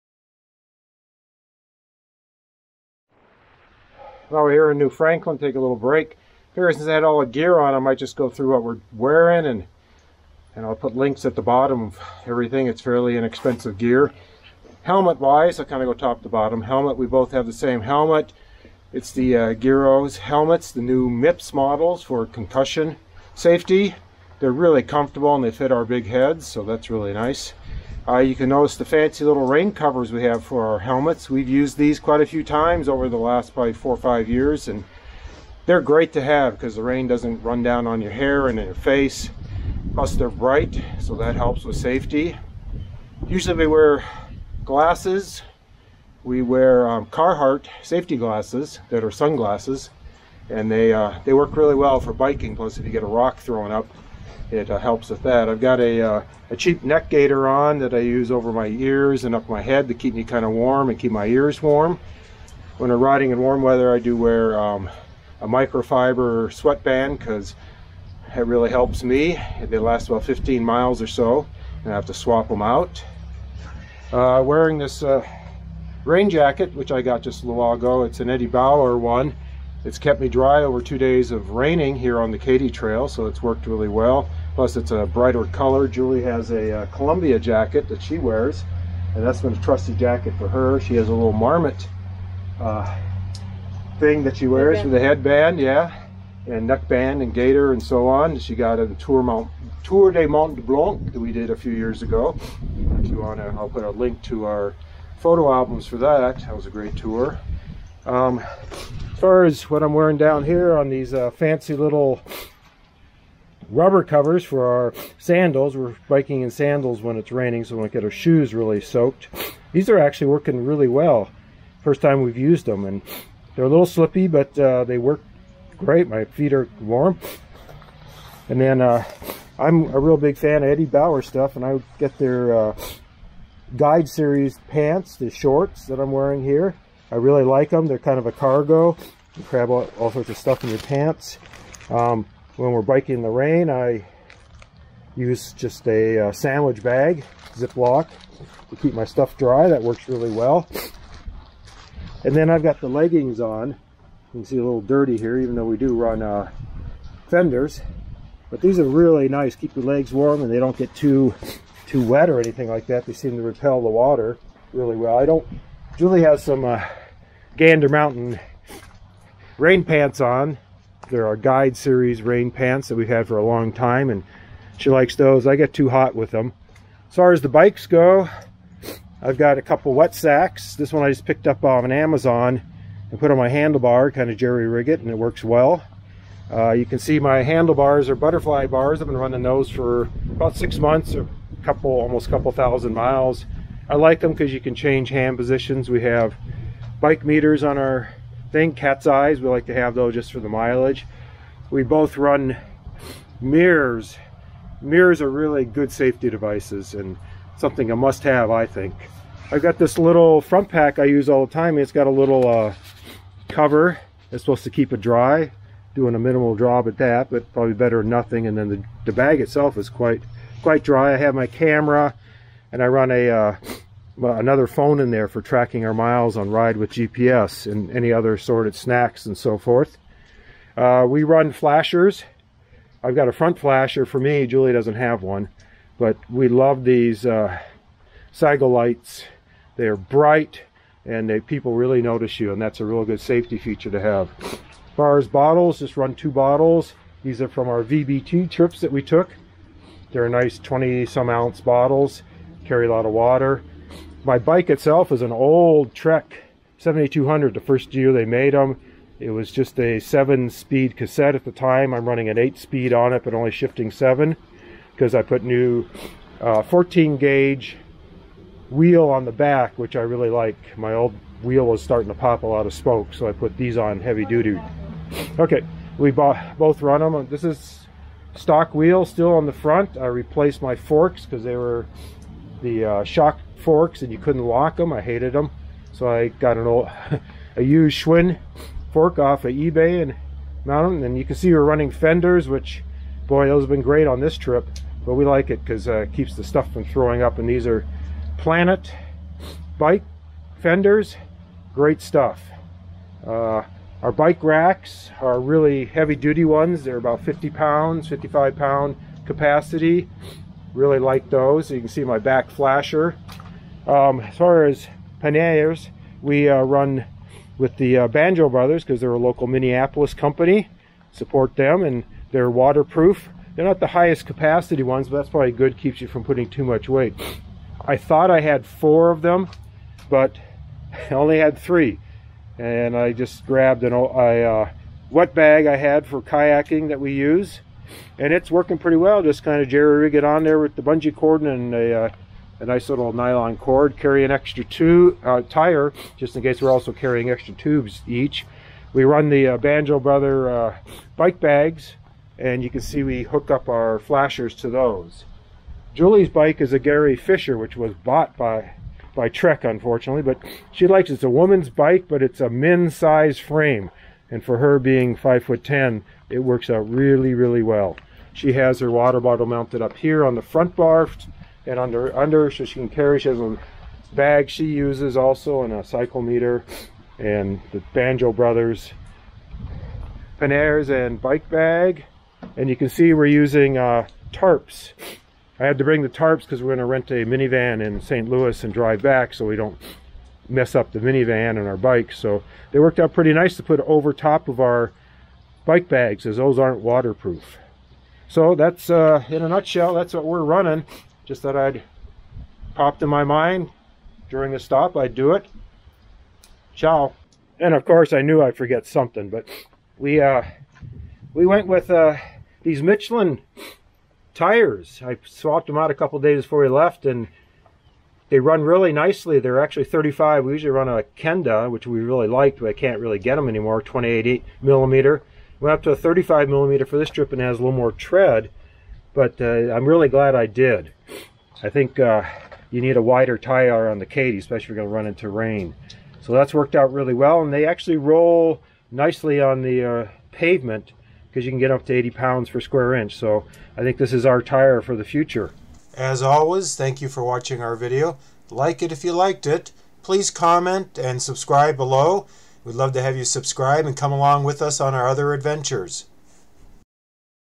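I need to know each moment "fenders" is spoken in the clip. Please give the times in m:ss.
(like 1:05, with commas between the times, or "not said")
2:37, 4:51, 5:00.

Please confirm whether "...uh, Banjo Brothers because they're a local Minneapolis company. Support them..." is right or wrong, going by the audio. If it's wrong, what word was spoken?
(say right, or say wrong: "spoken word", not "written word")
right.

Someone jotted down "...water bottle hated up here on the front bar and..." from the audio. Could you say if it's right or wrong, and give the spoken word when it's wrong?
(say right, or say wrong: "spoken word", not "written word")
wrong: "mounted", not "hated".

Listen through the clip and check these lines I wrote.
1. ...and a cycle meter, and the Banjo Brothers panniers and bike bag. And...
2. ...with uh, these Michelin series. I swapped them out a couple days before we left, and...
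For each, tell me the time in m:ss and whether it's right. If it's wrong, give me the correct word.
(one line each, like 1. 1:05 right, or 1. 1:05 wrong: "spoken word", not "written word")
1. 6:15 right
2. 6:51 wrong: "tires", not "series".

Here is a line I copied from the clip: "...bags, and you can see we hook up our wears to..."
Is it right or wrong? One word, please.
wrong.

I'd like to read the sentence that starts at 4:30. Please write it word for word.
My old wheel was starting to pop a lot of smoke, so I put these on heavy duty.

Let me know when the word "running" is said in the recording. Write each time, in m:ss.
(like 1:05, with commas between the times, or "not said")
3:09, 4:22, 4:51, 6:40.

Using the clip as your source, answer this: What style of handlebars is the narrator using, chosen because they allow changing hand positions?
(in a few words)
Butterfly bars.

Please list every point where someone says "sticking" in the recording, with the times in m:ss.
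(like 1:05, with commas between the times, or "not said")
not said.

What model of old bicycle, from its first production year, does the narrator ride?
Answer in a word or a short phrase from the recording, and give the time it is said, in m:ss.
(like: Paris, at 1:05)
Trek 7200, at 4:15.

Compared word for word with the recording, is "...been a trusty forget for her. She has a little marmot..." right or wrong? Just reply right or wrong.
wrong.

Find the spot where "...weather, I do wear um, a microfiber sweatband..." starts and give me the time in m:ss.
1:03.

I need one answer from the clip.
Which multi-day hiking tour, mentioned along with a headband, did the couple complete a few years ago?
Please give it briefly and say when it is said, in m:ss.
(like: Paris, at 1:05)
Tour de Mont Blanc, at 1:39.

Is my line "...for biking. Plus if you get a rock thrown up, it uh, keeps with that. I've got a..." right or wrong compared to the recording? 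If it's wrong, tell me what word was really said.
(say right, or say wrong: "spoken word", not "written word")
wrong: "helps", not "keeps".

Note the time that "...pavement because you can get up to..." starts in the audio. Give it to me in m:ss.
7:20.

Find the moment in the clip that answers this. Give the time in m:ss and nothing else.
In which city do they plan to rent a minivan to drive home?
6:28.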